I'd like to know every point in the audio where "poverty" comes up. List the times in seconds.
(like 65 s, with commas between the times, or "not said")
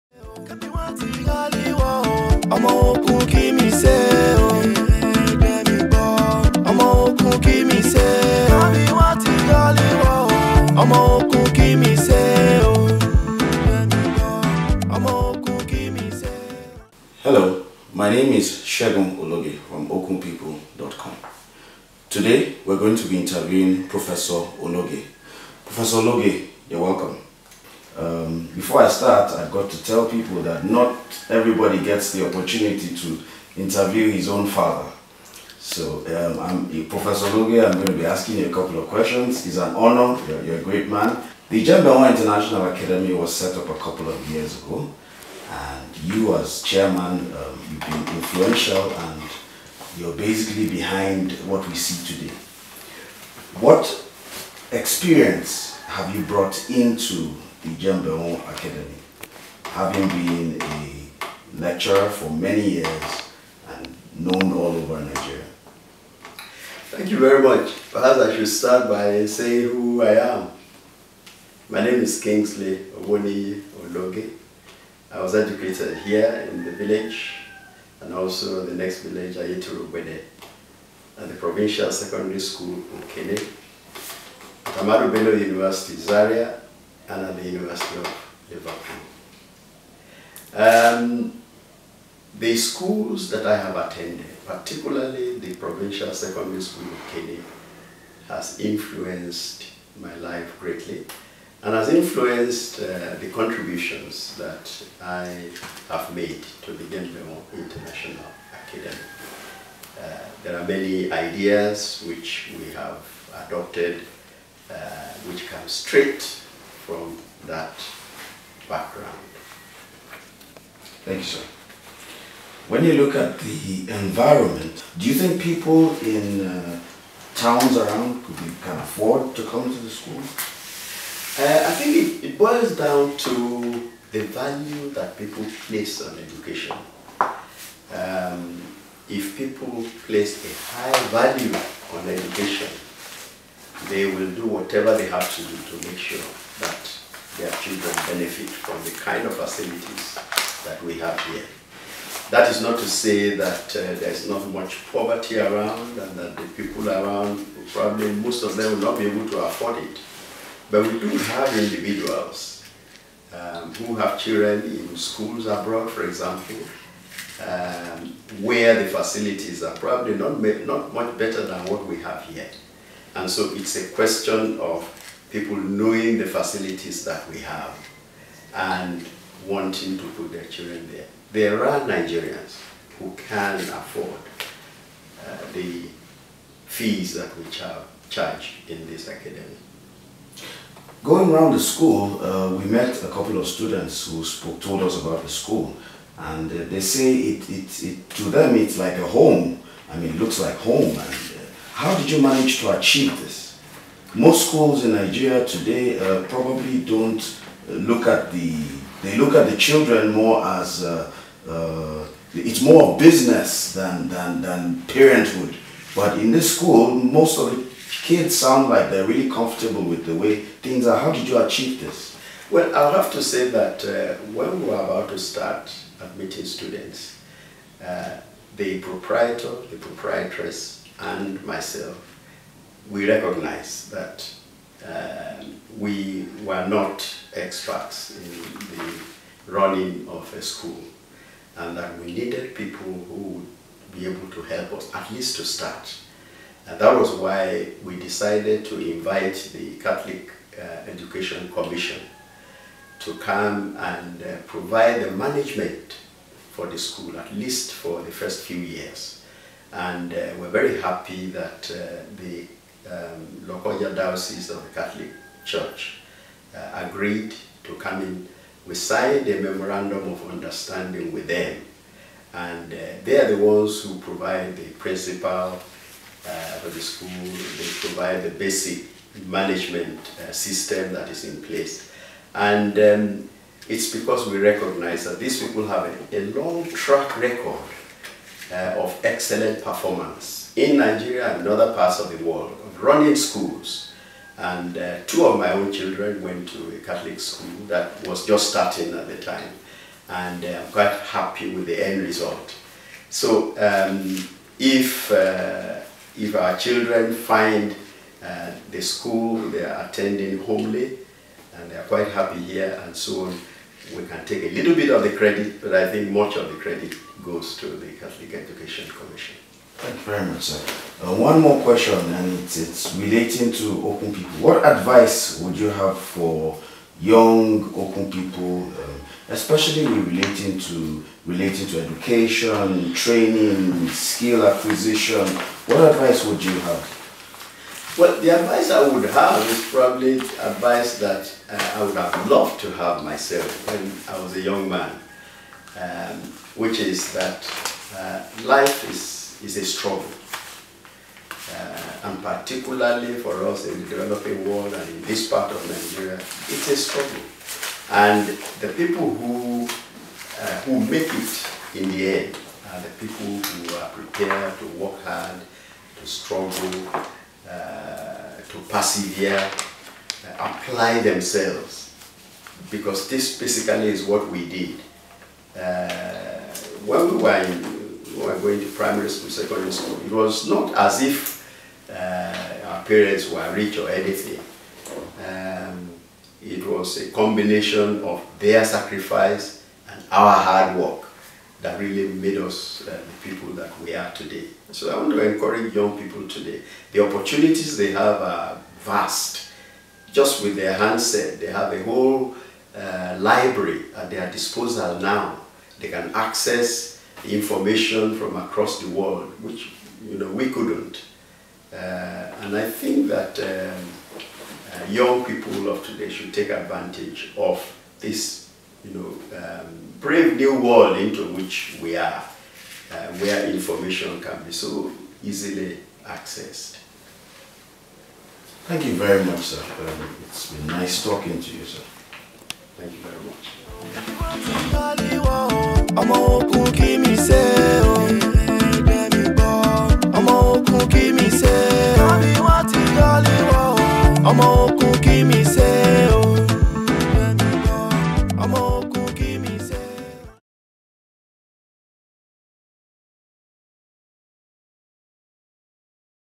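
154 s.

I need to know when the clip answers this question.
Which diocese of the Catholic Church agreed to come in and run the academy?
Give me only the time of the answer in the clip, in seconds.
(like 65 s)
263 s.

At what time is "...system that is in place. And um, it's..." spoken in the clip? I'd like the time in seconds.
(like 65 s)
280 s.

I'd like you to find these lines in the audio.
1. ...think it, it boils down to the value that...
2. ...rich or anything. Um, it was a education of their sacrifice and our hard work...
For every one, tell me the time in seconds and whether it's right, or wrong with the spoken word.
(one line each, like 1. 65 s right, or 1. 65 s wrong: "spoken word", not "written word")
1. 131 s right
2. 383 s wrong: "combination", not "education".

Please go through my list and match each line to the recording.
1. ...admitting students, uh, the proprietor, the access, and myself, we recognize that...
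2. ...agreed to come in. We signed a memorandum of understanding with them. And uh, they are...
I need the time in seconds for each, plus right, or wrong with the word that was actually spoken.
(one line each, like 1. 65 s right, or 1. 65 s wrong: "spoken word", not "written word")
1. 225 s wrong: "proprietress", not "access"
2. 266 s right.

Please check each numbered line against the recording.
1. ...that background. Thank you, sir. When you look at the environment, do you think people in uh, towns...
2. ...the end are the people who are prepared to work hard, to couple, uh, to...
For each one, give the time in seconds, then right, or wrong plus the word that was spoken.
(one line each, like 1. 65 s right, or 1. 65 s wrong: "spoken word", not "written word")
1. 117 s right
2. 361 s wrong: "struggle", not "couple".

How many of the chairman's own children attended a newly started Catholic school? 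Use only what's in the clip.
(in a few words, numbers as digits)
2.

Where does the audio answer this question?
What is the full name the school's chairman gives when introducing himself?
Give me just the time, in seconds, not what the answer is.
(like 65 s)
72 s.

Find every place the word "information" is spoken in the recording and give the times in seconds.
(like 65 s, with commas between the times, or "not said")
407 s, 423 s.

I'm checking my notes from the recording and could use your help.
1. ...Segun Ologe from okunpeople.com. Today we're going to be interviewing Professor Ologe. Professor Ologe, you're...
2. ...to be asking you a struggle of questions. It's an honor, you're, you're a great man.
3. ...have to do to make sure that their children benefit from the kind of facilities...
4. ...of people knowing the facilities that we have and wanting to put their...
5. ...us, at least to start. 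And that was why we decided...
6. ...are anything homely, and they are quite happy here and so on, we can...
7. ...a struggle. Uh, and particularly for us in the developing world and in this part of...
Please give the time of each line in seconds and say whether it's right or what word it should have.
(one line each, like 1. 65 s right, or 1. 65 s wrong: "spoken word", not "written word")
1. 18 s right
2. 37 s wrong: "couple", not "struggle"
3. 145 s right
4. 174 s right
5. 244 s right
6. 309 s wrong: "attending", not "anything"
7. 349 s right.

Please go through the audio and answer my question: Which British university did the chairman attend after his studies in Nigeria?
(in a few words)
University of Liverpool.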